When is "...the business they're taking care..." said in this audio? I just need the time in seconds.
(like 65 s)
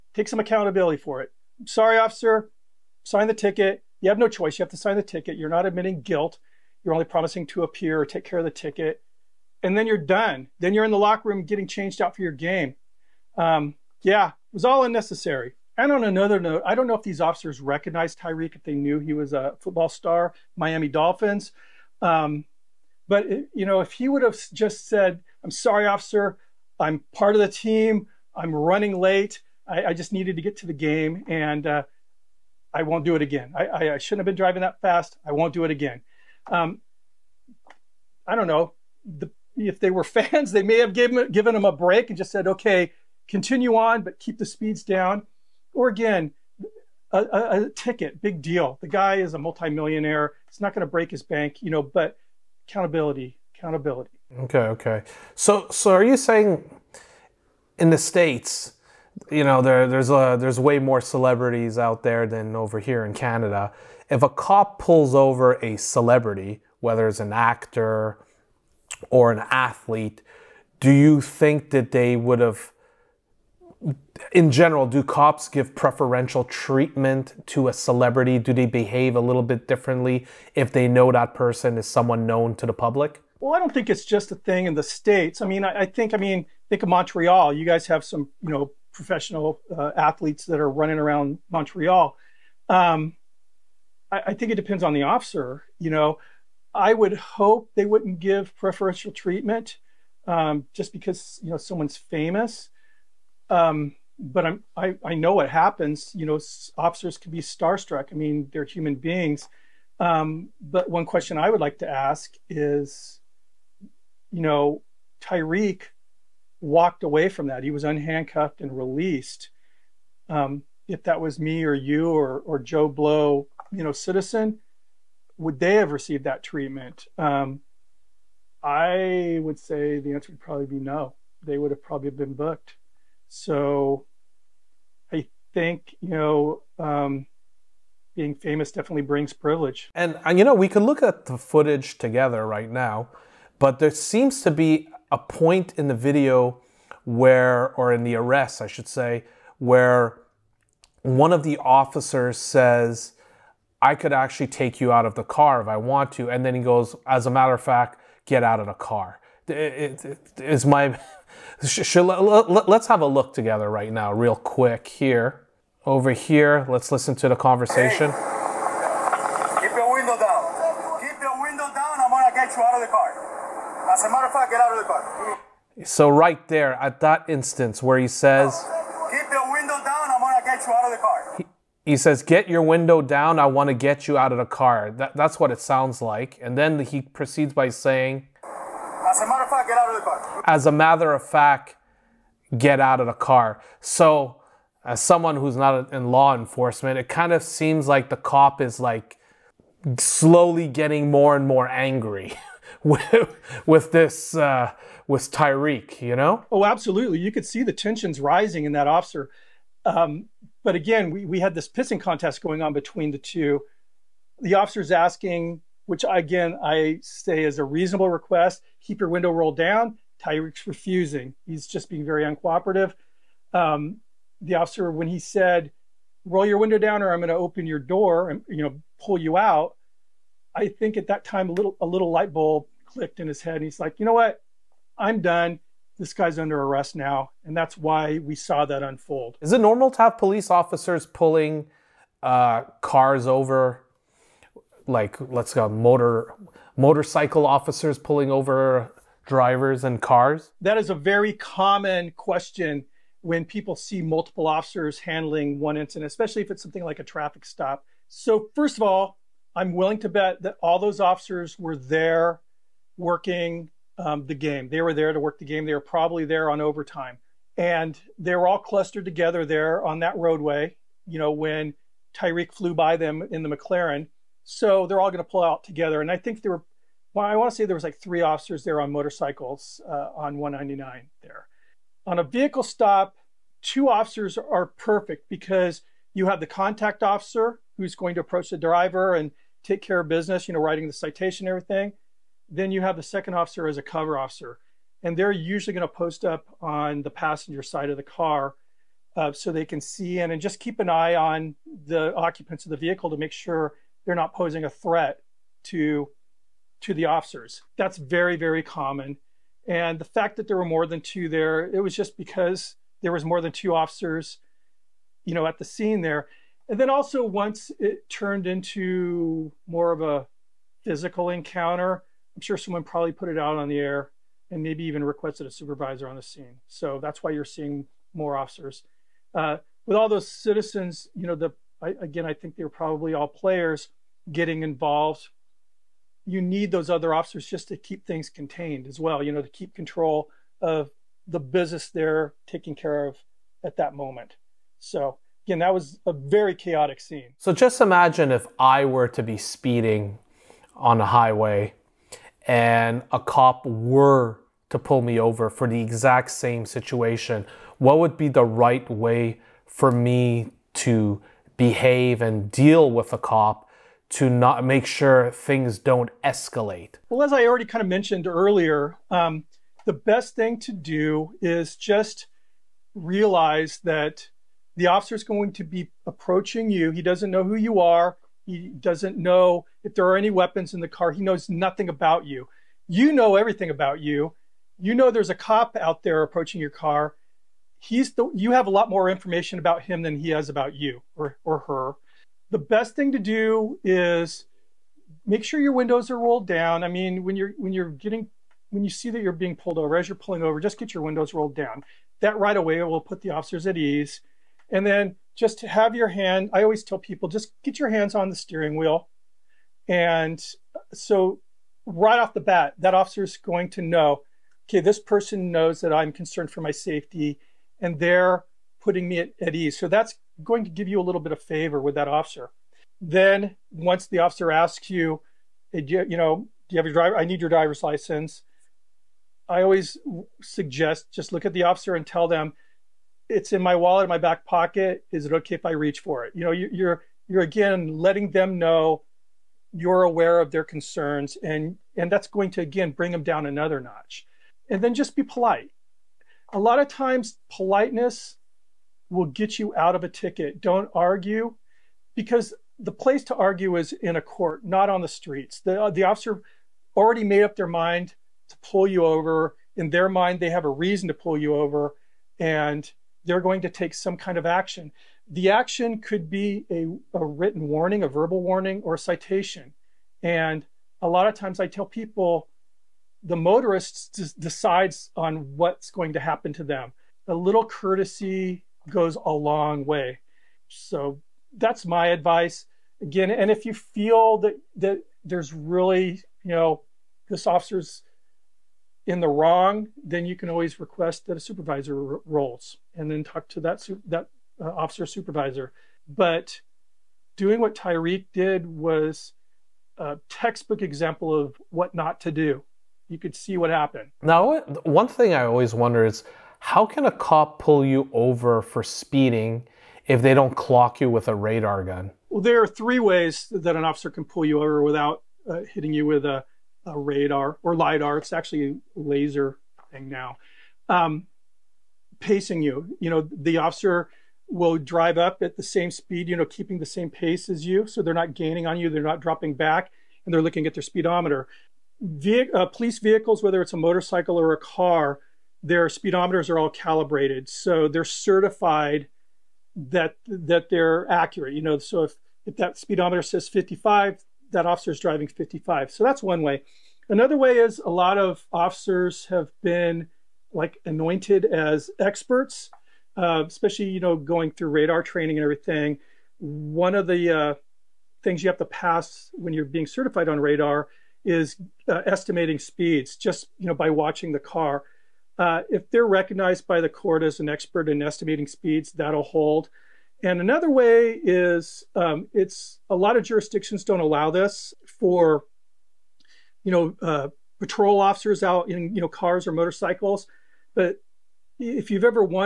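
341 s.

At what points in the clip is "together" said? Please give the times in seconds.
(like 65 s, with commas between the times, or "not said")
141 s, 163 s, 269 s, 275 s.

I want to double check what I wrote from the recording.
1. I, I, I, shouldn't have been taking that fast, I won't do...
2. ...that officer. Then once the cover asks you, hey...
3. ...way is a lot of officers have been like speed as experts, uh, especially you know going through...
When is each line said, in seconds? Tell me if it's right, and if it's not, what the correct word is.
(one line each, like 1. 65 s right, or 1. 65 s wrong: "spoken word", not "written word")
1. 33 s wrong: "driving", not "taking"
2. 421 s wrong: "officer", not "cover"
3. 547 s wrong: "anointed", not "speed".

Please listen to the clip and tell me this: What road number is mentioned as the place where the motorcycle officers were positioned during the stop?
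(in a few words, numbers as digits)
199.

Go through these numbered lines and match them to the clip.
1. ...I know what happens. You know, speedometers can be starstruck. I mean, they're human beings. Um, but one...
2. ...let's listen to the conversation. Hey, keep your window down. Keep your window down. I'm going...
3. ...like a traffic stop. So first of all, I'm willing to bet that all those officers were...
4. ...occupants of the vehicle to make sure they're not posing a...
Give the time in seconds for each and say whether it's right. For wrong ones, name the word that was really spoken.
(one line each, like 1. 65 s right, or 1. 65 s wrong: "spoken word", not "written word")
1. 105 s wrong: "officers", not "speedometers"
2. 166 s right
3. 256 s right
4. 302 s right.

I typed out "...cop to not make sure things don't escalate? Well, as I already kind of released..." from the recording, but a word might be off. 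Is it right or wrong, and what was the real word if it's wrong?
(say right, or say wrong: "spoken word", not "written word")
wrong: "mentioned", not "released".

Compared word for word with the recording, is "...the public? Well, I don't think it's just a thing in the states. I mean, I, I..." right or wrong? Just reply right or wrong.
right.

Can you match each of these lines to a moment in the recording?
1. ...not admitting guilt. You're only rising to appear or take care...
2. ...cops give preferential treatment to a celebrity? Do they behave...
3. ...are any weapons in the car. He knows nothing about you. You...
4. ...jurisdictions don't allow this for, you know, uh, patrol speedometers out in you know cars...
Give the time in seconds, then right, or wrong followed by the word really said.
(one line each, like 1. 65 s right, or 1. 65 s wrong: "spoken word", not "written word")
1. 5 s wrong: "promising", not "rising"
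2. 75 s right
3. 380 s right
4. 573 s wrong: "officers", not "speedometers".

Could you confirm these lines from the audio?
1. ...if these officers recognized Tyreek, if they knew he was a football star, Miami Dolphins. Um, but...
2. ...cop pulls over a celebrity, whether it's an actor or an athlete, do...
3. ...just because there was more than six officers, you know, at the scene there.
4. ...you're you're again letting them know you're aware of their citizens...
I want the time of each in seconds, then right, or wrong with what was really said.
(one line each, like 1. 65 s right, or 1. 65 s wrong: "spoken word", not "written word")
1. 16 s right
2. 64 s right
3. 311 s wrong: "two", not "six"
4. 436 s wrong: "concerns", not "citizens".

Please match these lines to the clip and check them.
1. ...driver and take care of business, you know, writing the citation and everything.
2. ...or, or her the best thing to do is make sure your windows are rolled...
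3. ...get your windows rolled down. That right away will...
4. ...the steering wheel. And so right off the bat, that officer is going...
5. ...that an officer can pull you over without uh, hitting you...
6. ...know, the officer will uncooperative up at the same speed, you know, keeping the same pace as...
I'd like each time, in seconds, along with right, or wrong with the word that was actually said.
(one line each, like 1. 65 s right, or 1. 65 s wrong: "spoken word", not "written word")
1. 288 s right
2. 391 s right
3. 400 s right
4. 408 s right
5. 513 s right
6. 523 s wrong: "drive", not "uncooperative".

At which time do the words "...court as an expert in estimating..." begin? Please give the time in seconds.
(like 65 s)
566 s.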